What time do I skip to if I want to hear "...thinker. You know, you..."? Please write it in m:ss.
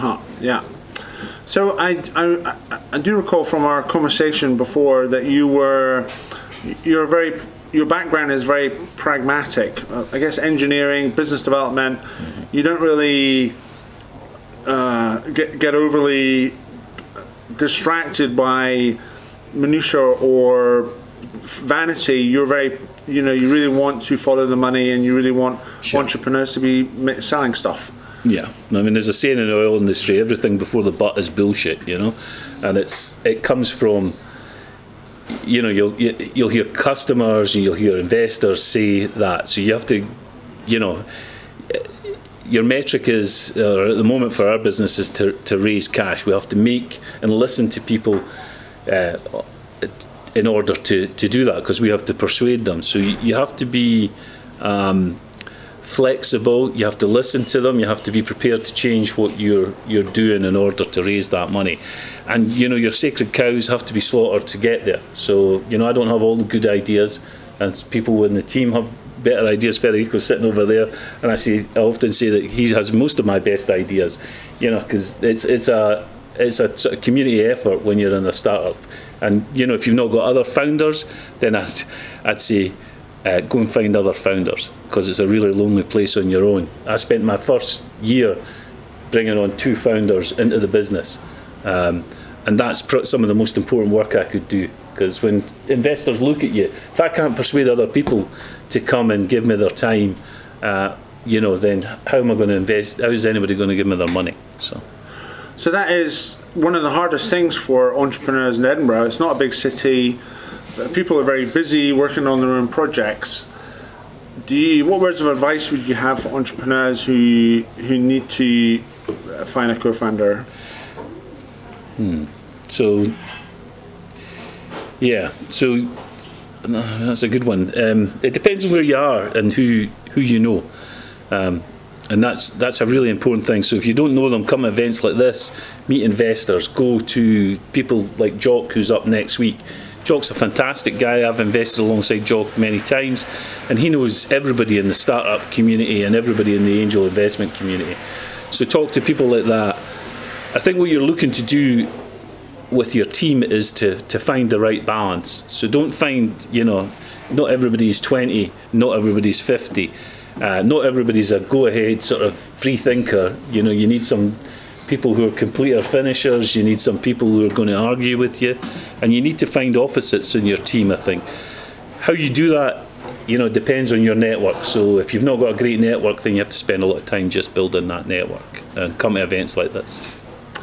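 2:42.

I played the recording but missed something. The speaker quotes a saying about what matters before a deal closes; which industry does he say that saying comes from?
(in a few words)
oil industry.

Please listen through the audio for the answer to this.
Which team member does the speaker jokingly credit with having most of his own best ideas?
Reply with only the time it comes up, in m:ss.
1:09.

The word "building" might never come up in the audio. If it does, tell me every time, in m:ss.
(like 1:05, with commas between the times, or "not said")
2:57.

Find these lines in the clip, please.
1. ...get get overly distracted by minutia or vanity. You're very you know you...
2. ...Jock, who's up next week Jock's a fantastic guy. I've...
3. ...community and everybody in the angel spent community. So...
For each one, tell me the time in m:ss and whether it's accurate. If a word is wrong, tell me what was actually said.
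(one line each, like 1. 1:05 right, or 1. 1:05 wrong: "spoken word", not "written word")
1. 0:15 right
2. 2:18 right
3. 2:25 wrong: "investment", not "spent".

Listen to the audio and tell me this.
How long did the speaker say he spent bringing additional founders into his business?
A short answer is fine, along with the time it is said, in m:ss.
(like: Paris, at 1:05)
first year, at 1:27.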